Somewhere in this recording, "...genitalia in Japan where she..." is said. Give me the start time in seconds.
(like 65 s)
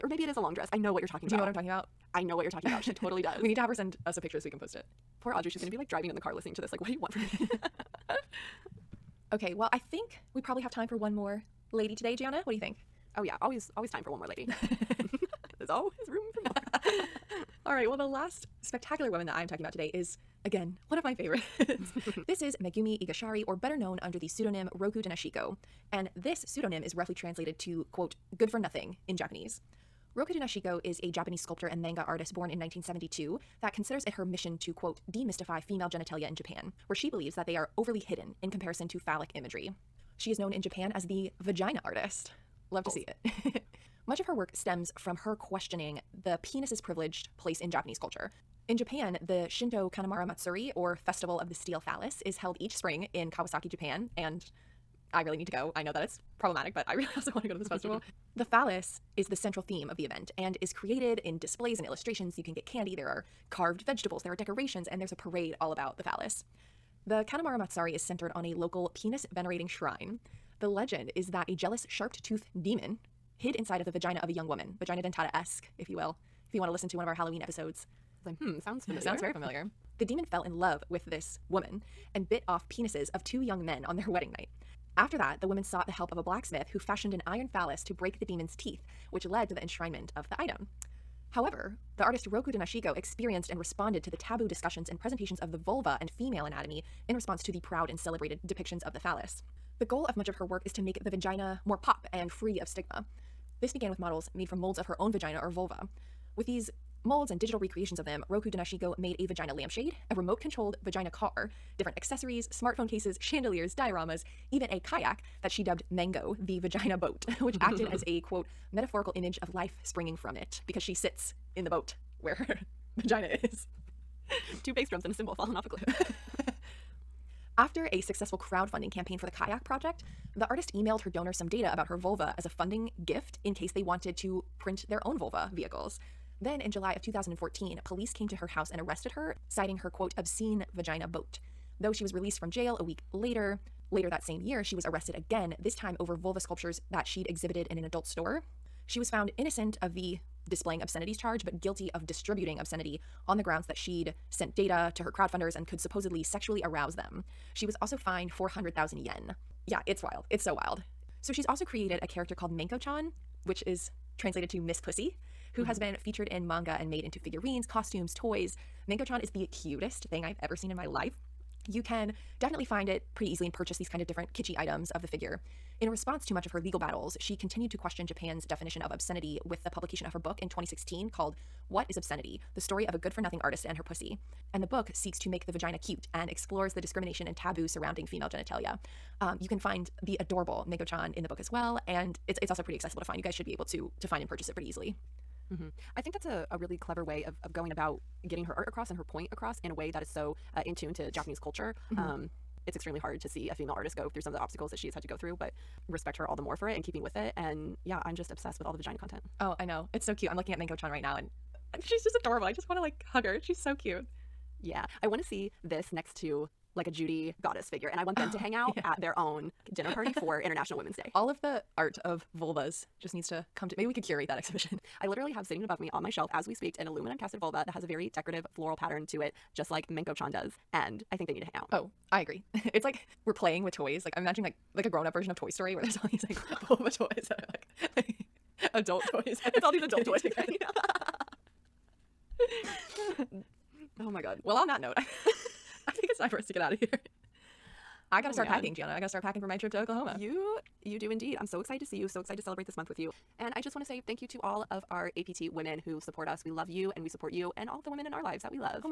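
35 s.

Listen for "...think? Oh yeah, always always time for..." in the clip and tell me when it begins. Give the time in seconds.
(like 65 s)
12 s.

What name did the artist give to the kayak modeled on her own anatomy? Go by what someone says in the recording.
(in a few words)
Mango.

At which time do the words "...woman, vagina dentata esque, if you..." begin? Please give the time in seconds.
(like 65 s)
74 s.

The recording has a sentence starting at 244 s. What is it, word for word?
Well, on that note think it's time for us to get out of here.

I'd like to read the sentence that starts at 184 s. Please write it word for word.
And the book seeks to make the vagina cute and explores the discrimination and taboo surrounding female genitalia.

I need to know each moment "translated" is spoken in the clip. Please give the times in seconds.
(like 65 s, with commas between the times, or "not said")
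27 s, 164 s.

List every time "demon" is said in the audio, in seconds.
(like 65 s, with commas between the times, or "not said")
72 s, 80 s, 88 s.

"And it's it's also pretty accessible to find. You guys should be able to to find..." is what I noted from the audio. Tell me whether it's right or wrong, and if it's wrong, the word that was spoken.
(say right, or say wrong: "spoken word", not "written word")
right.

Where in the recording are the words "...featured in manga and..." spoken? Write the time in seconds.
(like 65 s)
165 s.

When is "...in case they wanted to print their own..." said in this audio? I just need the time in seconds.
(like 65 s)
133 s.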